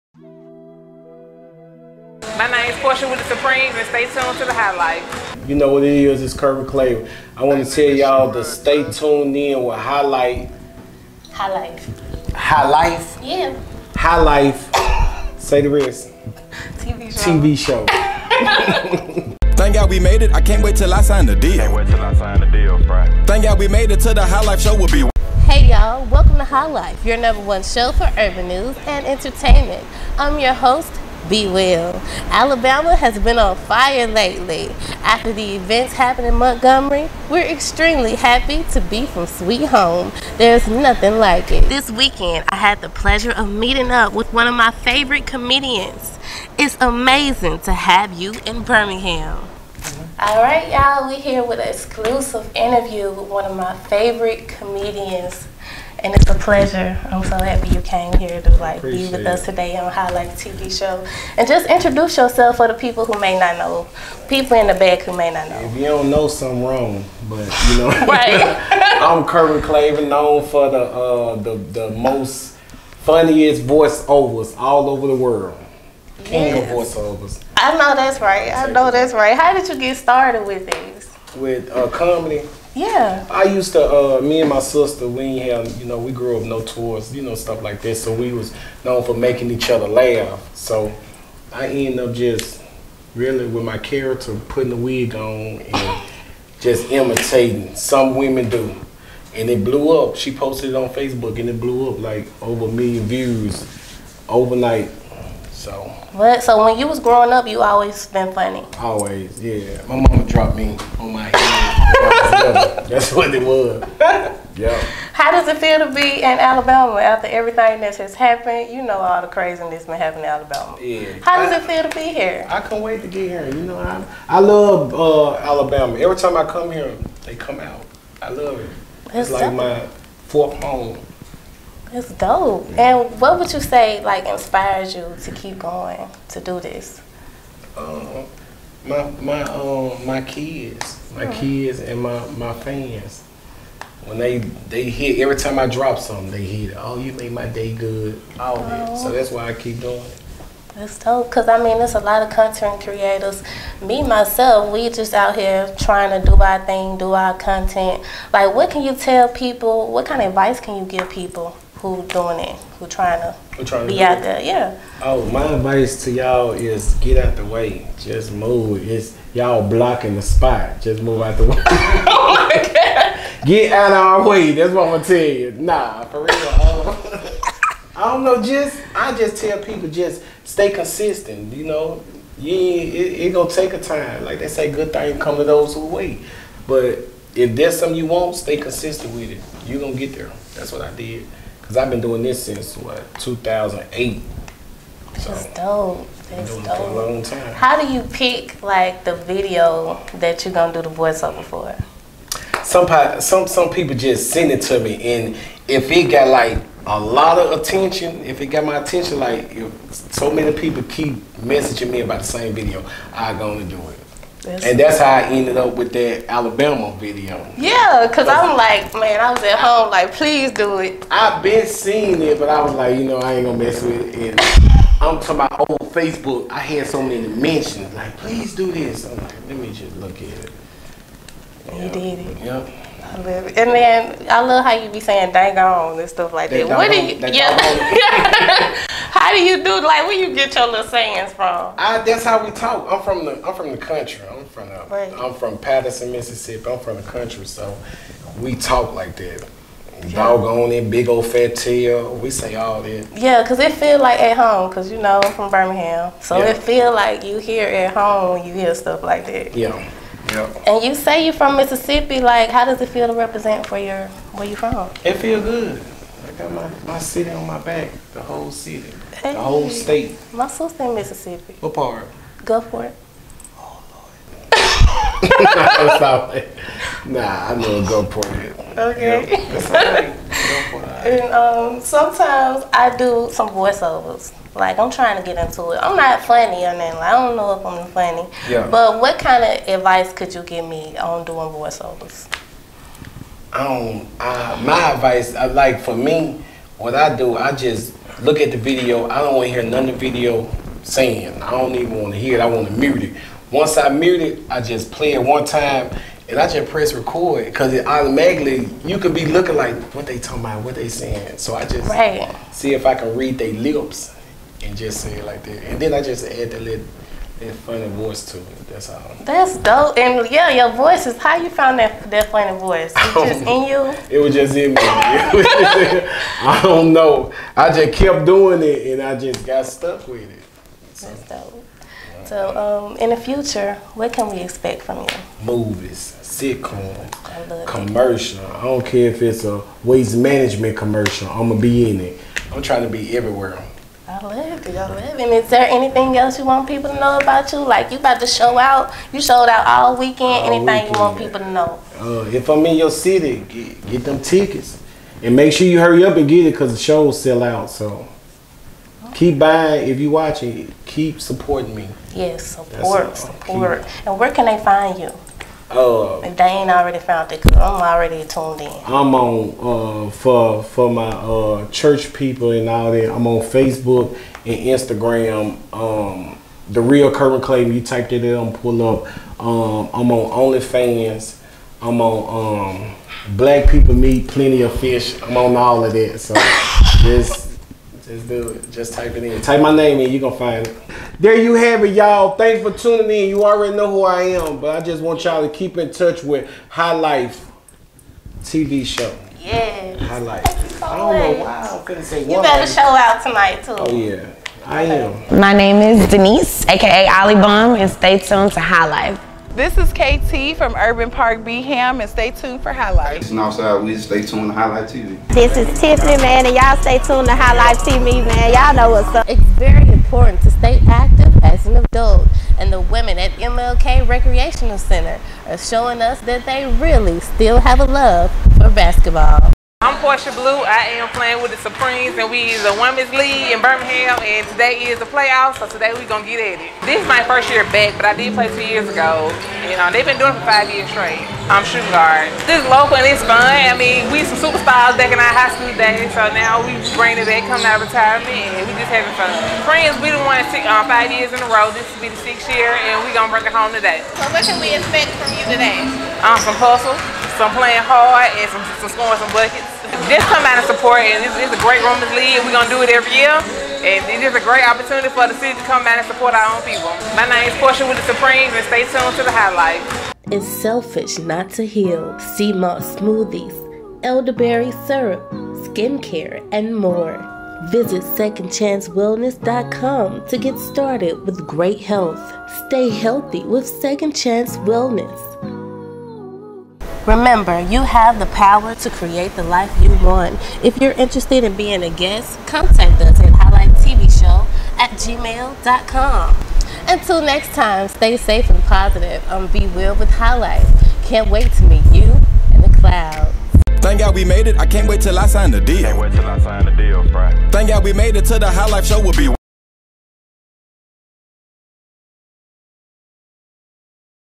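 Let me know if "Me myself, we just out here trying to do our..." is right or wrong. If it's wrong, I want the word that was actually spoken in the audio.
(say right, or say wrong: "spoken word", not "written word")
right.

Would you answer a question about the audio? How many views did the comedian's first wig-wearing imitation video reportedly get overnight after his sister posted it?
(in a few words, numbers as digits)
over a million.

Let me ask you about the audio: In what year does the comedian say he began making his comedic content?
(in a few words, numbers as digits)
2008.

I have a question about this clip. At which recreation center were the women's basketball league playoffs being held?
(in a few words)
MLK Recreational Center.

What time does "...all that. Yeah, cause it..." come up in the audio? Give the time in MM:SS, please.
04:12.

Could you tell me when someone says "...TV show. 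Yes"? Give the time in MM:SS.
06:38.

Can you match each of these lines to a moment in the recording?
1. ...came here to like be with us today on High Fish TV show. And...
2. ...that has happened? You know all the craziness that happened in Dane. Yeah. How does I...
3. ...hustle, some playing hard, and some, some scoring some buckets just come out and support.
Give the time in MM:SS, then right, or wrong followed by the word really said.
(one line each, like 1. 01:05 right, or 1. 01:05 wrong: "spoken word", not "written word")
1. 00:57 wrong: "Life", not "Fish"
2. 01:57 wrong: "Alabama", not "Dane"
3. 07:36 right.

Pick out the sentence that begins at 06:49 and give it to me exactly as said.
This is KT from Urban Park Beeham, and stay tuned for High Life.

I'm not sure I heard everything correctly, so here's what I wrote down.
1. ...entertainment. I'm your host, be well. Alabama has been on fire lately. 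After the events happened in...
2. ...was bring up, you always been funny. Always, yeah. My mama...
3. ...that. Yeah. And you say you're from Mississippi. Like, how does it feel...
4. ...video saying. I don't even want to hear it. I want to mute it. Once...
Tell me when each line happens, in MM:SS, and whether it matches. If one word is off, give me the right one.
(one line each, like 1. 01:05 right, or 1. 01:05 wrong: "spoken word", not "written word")
1. 00:29 right
2. 01:46 wrong: "growing", not "bring"
3. 04:19 right
4. 05:00 right.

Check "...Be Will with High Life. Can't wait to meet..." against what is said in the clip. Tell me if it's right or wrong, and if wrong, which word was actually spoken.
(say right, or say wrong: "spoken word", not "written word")
right.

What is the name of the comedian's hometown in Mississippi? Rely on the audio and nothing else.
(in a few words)
Patterson.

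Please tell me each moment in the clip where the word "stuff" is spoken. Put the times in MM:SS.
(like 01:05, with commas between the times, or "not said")
01:27, 03:56, 04:18.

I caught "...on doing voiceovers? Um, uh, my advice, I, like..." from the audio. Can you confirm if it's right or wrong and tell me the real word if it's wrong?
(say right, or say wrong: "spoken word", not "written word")
right.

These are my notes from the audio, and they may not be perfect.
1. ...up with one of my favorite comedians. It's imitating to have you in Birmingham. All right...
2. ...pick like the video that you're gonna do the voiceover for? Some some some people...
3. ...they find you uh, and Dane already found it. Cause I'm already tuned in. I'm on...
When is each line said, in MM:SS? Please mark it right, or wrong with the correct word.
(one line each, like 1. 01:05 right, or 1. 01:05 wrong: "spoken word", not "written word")
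1. 00:43 wrong: "amazing", not "imitating"
2. 03:18 right
3. 06:04 right.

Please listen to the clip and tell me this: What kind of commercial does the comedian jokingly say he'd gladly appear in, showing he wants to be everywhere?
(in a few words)
waste management.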